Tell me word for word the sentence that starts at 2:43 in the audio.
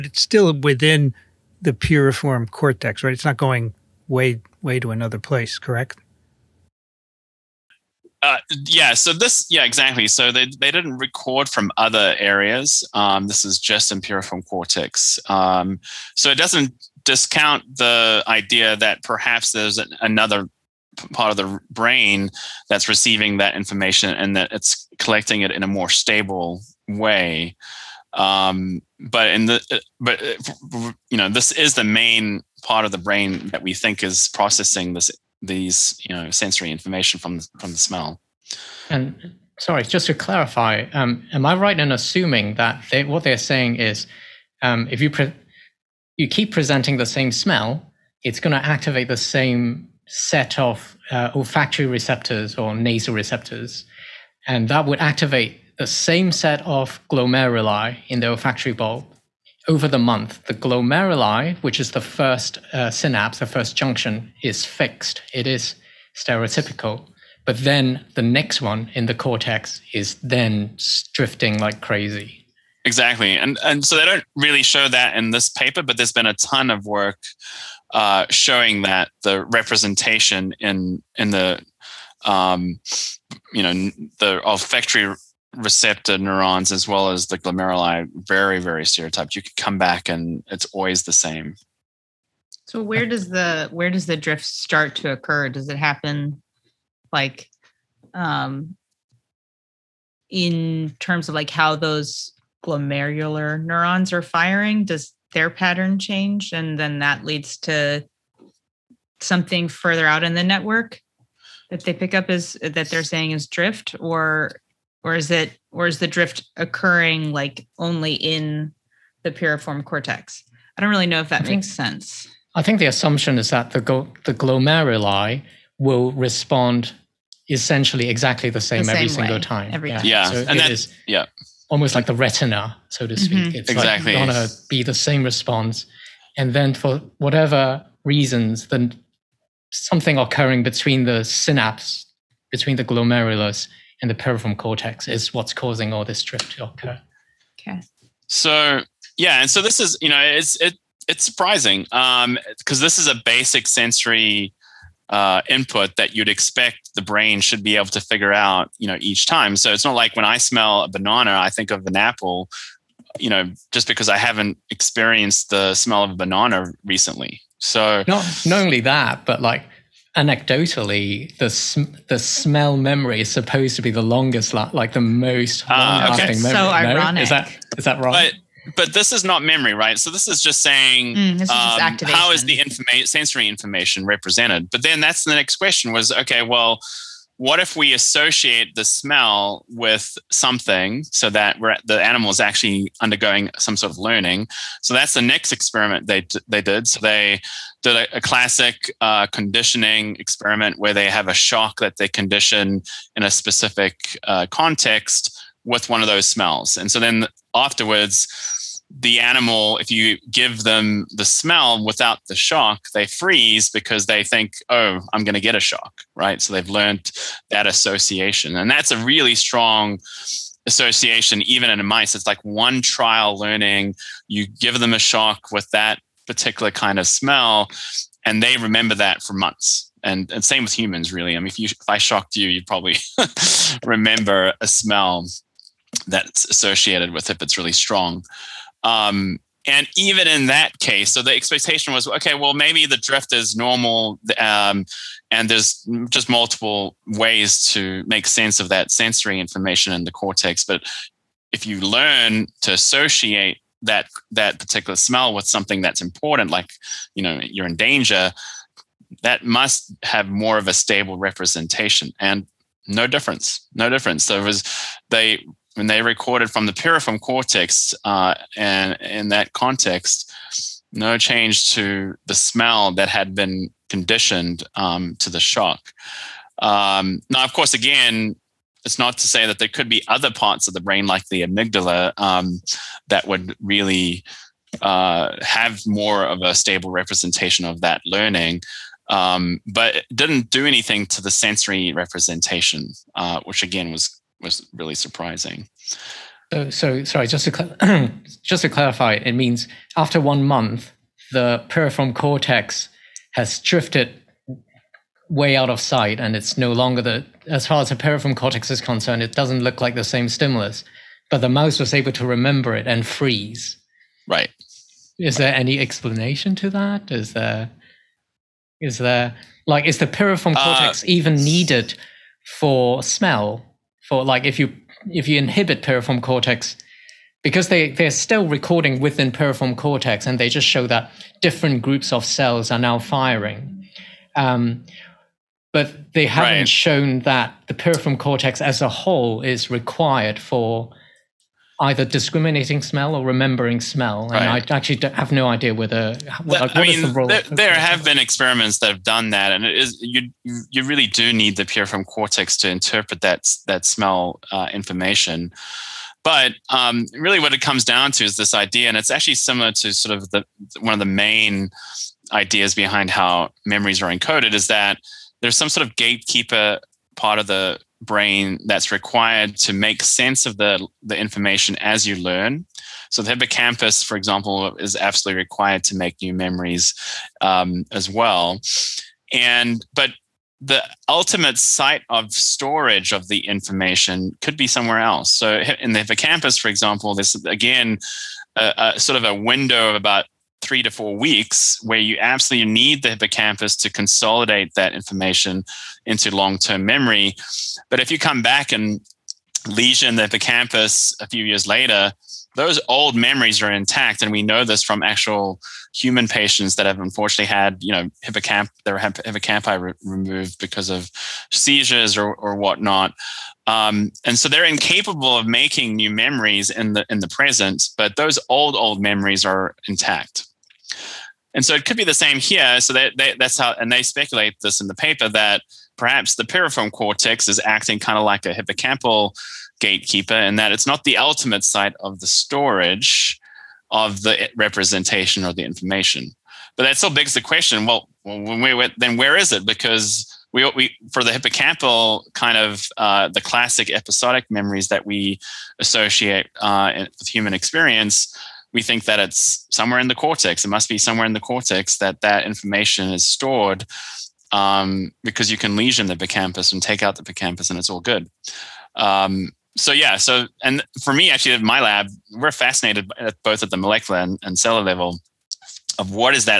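You know, just because I haven't experienced the smell of a banana recently.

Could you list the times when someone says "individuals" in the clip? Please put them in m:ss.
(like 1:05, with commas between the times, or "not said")
not said.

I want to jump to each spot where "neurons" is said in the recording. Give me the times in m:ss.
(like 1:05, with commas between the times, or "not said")
1:26, 1:43.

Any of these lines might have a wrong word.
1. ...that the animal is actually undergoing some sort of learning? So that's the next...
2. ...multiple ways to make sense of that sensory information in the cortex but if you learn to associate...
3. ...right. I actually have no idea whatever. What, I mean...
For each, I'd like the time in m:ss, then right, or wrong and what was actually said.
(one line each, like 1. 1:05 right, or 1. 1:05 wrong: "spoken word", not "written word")
1. 3:11 right
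2. 4:06 right
3. 5:44 wrong: "whether", not "whatever".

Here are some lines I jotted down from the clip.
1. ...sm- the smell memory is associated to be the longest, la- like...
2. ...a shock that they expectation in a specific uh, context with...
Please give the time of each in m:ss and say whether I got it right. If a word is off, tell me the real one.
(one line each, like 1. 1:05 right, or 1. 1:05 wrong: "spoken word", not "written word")
1. 2:51 wrong: "supposed", not "associated"
2. 3:21 wrong: "condition", not "expectation".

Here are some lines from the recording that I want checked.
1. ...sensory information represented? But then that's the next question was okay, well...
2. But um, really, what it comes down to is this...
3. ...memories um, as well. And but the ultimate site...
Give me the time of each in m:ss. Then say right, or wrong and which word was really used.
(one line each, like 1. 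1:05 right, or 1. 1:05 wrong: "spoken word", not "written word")
1. 3:03 right
2. 5:56 right
3. 6:16 right.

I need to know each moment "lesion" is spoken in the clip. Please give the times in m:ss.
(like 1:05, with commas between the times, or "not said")
6:39, 7:35.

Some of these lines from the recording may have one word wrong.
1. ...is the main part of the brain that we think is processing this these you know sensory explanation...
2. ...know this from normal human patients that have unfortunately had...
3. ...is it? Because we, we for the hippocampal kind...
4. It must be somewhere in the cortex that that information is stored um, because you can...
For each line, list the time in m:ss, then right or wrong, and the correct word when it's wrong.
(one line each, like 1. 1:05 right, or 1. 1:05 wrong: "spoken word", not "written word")
1. 0:31 wrong: "information", not "explanation"
2. 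6:44 wrong: "actual", not "normal"
3. 7:19 right
4. 7:30 right.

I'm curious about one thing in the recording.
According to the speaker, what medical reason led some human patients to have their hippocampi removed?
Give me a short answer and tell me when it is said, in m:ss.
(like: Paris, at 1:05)
seizures, at 6:51.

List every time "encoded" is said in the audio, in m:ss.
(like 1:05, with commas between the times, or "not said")
6:04.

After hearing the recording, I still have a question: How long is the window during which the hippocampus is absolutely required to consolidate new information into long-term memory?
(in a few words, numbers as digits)
3 to 4 weeks.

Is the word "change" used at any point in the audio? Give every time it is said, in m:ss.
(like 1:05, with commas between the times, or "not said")
1:45, 4:31.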